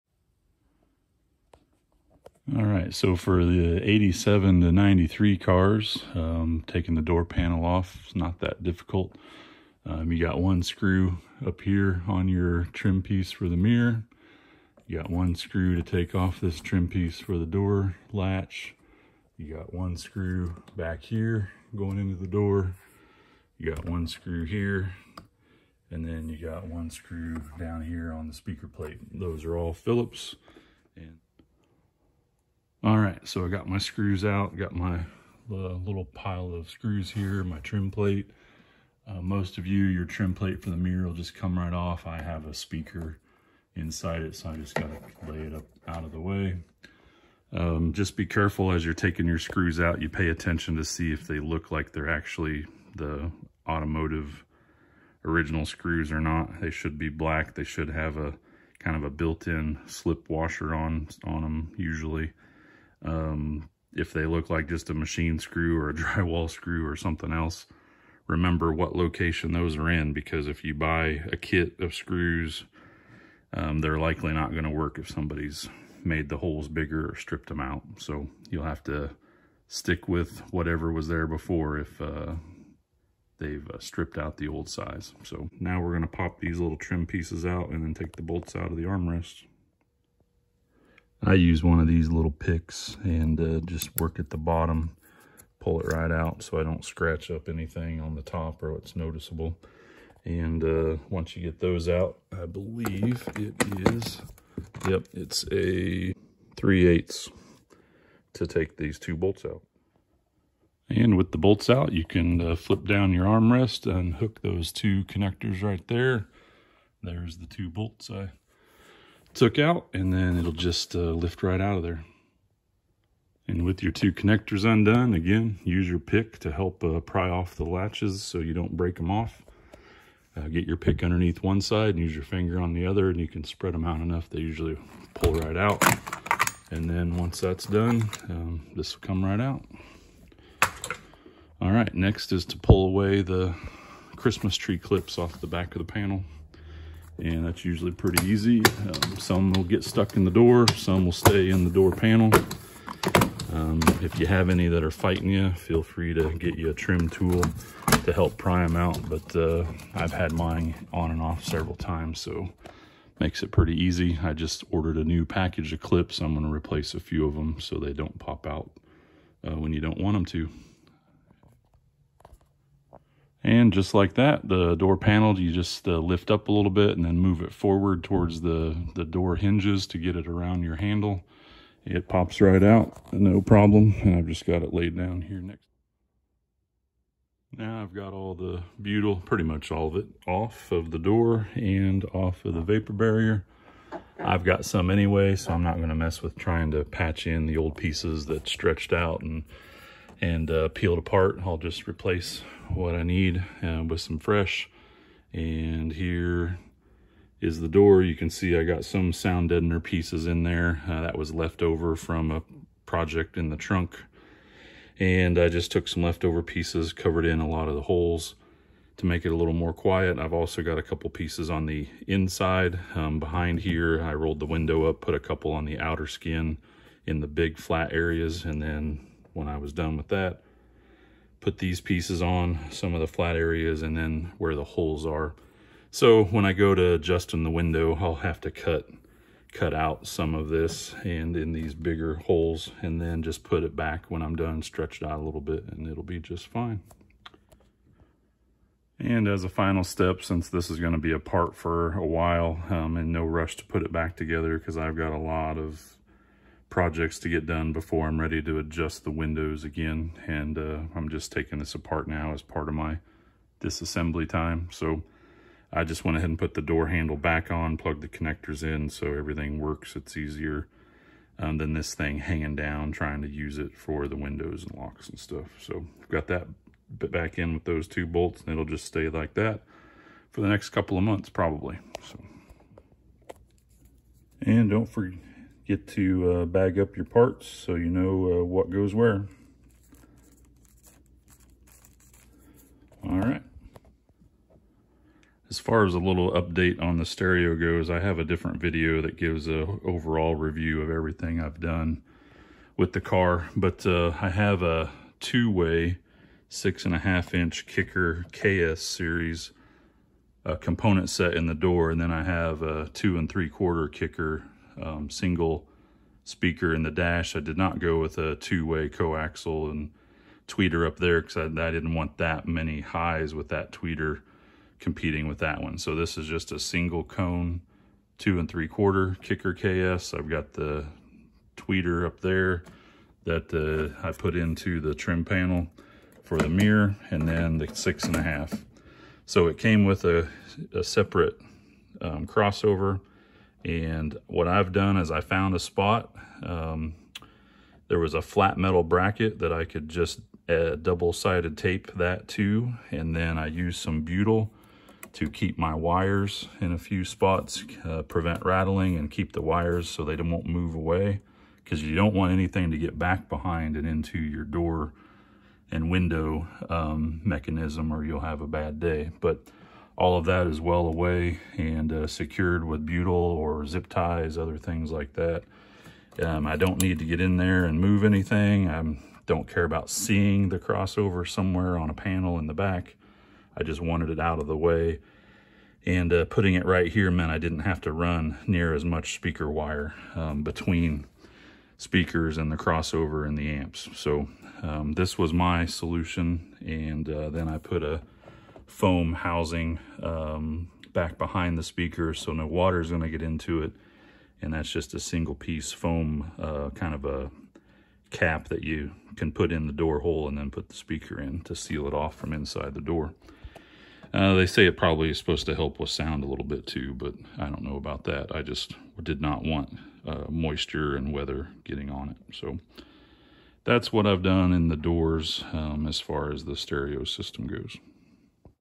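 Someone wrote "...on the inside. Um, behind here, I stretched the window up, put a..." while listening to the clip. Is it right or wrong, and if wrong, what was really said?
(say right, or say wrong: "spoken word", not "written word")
wrong: "rolled", not "stretched".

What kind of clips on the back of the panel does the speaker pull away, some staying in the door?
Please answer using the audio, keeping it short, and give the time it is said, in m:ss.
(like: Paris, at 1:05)
Christmas tree clips, at 2:24.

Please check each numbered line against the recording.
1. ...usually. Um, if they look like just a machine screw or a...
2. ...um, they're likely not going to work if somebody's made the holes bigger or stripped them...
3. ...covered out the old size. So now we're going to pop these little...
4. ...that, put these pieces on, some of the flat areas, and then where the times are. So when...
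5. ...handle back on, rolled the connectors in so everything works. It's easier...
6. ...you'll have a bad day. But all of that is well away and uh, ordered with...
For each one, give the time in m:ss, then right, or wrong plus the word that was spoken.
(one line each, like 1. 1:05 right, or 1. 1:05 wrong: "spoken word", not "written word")
1. 1:01 right
2. 1:13 right
3. 1:23 wrong: "stripped", not "covered"
4. 3:50 wrong: "holes", not "times"
5. 4:26 wrong: "plugged", not "rolled"
6. 6:08 wrong: "secured", not "ordered".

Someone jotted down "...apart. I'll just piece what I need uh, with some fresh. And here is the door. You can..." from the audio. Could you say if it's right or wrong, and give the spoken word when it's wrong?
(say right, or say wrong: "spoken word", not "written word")
wrong: "replace", not "piece".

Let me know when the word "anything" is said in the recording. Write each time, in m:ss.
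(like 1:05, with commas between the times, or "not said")
1:37, 6:02, 6:18.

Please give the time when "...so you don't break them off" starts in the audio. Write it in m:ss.
2:08.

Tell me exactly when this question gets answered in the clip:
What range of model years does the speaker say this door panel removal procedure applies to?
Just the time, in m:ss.
0:03.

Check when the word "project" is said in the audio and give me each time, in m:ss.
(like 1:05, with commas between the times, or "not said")
3:32, 4:16.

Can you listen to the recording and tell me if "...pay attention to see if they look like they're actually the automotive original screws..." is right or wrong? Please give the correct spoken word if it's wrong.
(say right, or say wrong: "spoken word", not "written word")
right.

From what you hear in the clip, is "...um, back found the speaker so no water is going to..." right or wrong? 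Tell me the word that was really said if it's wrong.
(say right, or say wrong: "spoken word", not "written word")
wrong: "behind", not "found".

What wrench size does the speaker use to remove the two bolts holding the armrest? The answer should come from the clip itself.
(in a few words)
3/8.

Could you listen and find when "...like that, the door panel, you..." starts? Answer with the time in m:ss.
2:53.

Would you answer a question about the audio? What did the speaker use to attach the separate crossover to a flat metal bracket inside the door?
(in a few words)
Double-sided tape.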